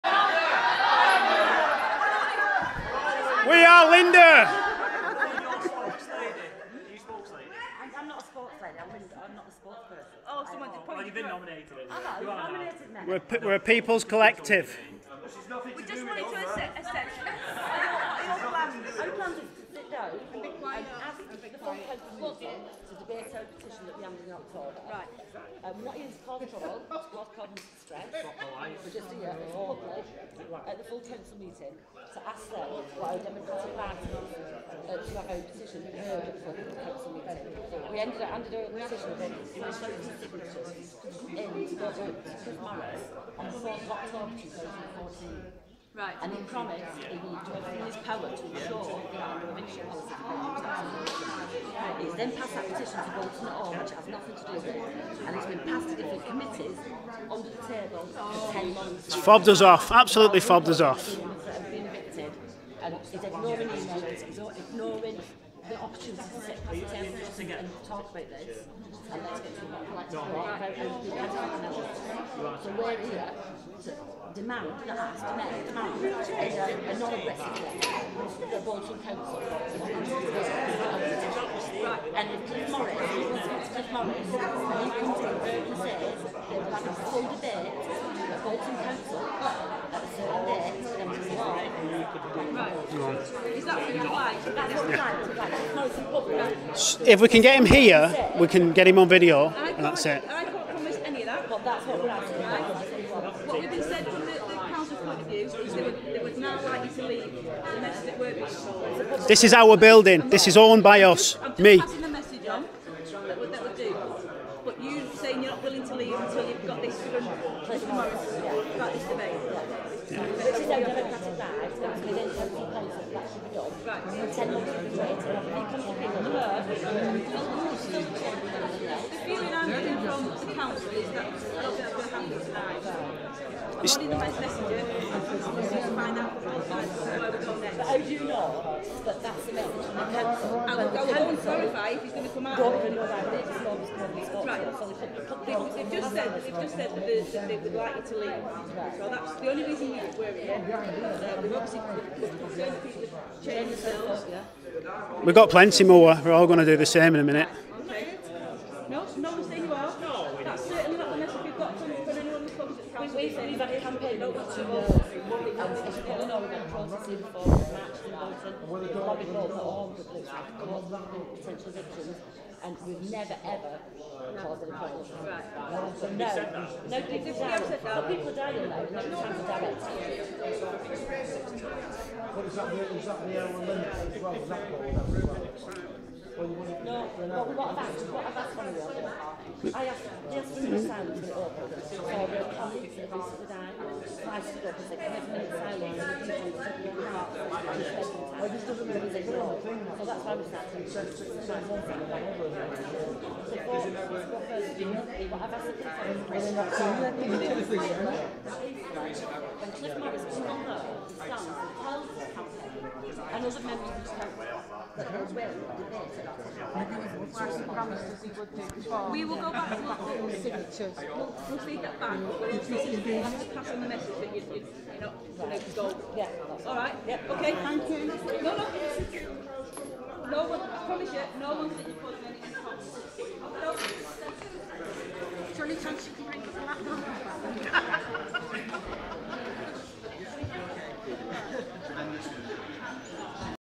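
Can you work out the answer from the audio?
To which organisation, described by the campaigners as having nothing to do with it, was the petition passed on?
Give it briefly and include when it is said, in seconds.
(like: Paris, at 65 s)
Bolton at Home, at 53 s.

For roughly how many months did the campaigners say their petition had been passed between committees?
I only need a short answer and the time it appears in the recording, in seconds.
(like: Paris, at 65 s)
10 months, at 58 s.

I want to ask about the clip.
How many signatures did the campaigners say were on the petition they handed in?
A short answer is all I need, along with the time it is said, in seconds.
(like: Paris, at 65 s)
1,600, at 39 s.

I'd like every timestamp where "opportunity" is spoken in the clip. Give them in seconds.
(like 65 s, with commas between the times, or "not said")
65 s.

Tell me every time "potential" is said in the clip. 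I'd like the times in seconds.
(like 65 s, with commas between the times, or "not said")
171 s.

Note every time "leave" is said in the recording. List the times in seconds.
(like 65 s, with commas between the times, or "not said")
107 s, 115 s, 148 s.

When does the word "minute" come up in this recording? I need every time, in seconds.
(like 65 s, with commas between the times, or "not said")
157 s, 195 s.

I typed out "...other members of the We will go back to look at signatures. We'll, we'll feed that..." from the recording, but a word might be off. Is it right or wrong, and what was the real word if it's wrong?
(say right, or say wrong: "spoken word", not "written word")
right.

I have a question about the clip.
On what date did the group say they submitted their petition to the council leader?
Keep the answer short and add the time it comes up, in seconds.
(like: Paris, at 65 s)
4 October 2014, at 43 s.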